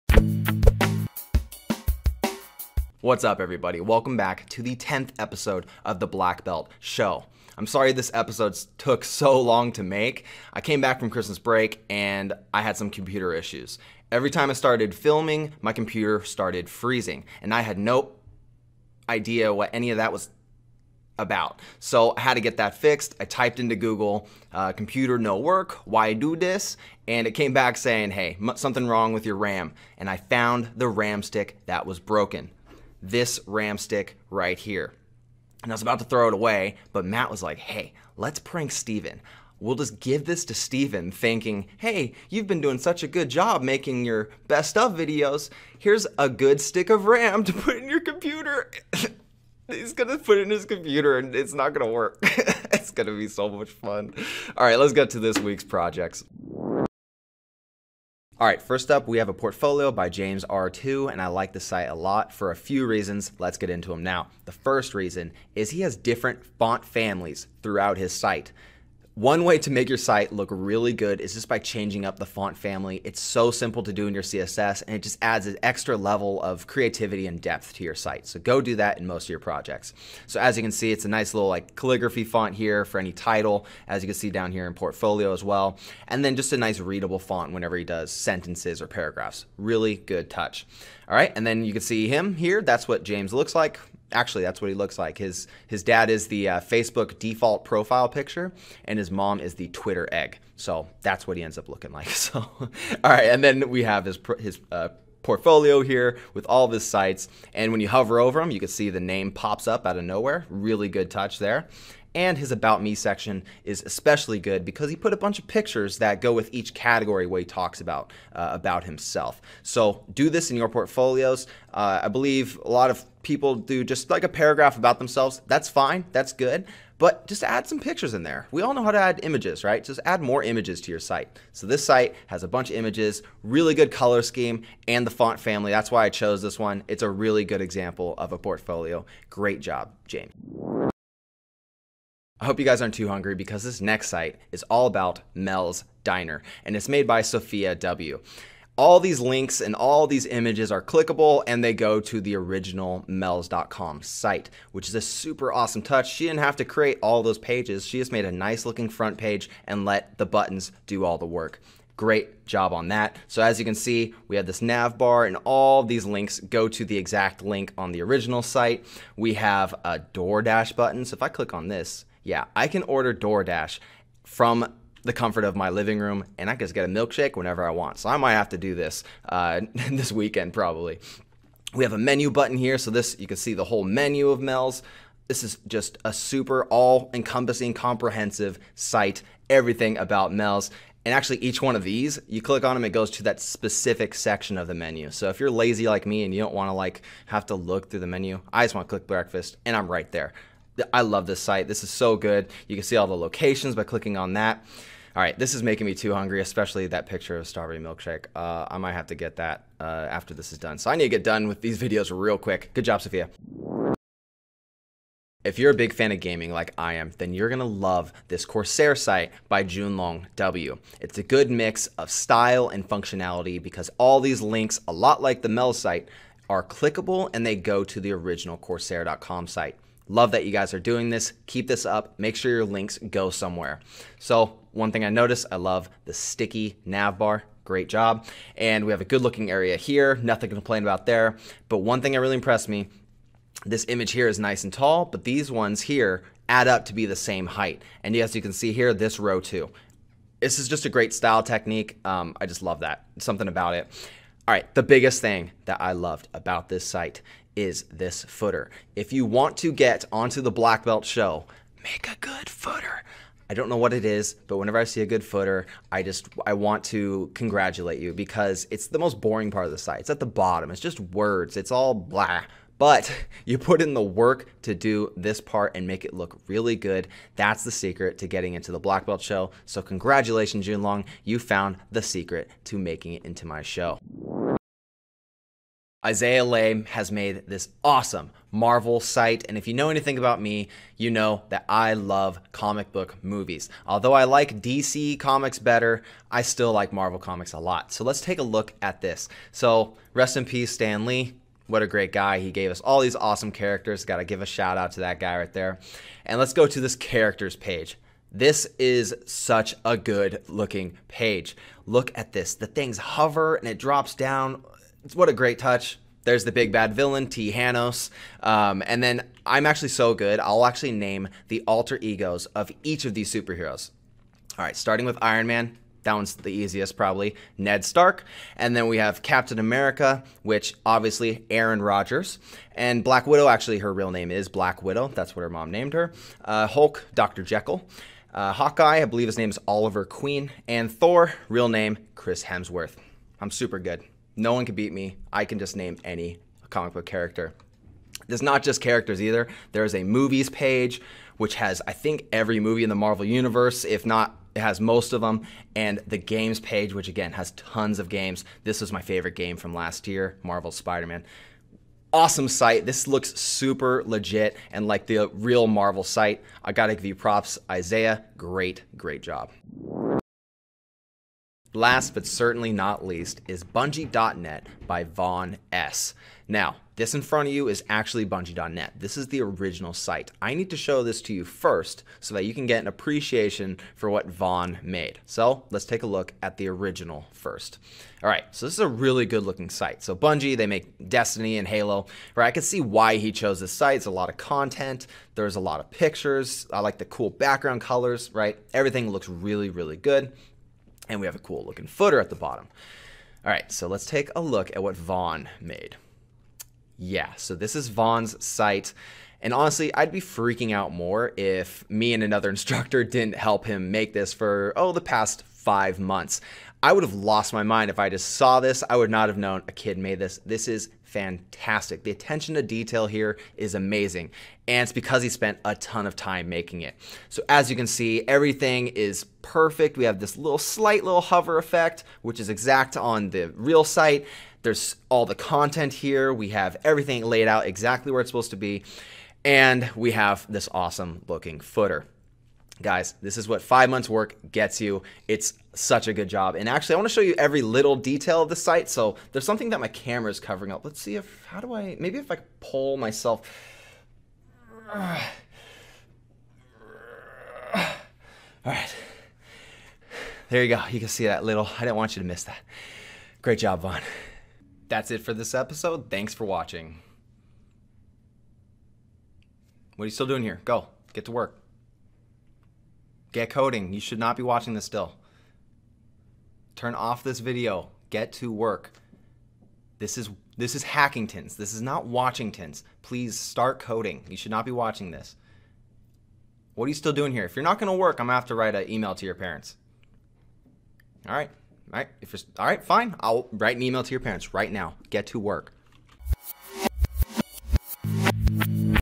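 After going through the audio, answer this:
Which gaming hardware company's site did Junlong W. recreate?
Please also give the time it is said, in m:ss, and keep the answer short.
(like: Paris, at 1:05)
Corsair, at 3:38.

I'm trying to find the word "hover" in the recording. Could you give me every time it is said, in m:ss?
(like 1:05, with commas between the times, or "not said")
1:47, 5:12, 7:11.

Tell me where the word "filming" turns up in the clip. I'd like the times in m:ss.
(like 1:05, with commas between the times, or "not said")
0:14.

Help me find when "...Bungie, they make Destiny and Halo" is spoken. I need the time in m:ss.
6:30.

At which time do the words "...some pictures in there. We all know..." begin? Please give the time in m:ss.
2:07.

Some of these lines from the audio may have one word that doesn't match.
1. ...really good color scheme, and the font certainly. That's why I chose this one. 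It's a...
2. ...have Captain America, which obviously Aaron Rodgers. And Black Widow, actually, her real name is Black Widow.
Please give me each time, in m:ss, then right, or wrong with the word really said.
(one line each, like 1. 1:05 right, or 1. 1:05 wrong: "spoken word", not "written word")
1. 2:13 wrong: "family", not "certainly"
2. 5:28 right.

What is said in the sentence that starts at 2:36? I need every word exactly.
She didn't have to create all those pages.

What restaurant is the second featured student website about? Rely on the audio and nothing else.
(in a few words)
Mel's Diner.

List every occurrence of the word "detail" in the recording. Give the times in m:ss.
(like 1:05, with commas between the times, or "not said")
7:02, 7:27.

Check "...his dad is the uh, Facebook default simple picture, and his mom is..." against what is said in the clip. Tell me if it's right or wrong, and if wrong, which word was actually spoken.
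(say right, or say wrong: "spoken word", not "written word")
wrong: "profile", not "simple".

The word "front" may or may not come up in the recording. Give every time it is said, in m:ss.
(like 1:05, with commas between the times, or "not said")
2:38, 6:17.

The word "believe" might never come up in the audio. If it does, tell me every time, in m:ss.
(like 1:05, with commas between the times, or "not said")
2:02, 5:39.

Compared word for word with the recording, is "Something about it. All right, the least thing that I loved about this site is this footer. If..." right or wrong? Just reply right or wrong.
wrong.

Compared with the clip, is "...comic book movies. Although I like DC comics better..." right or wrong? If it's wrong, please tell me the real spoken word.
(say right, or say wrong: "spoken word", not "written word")
right.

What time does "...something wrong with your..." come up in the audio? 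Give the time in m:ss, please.
0:28.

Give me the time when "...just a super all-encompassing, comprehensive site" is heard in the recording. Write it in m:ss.
3:05.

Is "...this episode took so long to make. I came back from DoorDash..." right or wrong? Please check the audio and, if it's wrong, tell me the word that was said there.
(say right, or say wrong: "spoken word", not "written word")
wrong: "Christmas", not "DoorDash".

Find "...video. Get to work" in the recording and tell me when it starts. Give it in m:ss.
7:57.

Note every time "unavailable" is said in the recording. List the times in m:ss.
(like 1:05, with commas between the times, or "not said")
not said.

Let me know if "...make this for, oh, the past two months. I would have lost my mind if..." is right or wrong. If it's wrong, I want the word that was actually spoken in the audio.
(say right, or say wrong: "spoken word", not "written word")
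wrong: "five", not "two".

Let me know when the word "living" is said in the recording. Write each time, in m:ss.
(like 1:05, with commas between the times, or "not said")
2:55.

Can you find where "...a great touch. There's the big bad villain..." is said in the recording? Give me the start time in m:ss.
5:15.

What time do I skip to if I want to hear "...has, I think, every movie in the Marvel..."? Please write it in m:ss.
5:51.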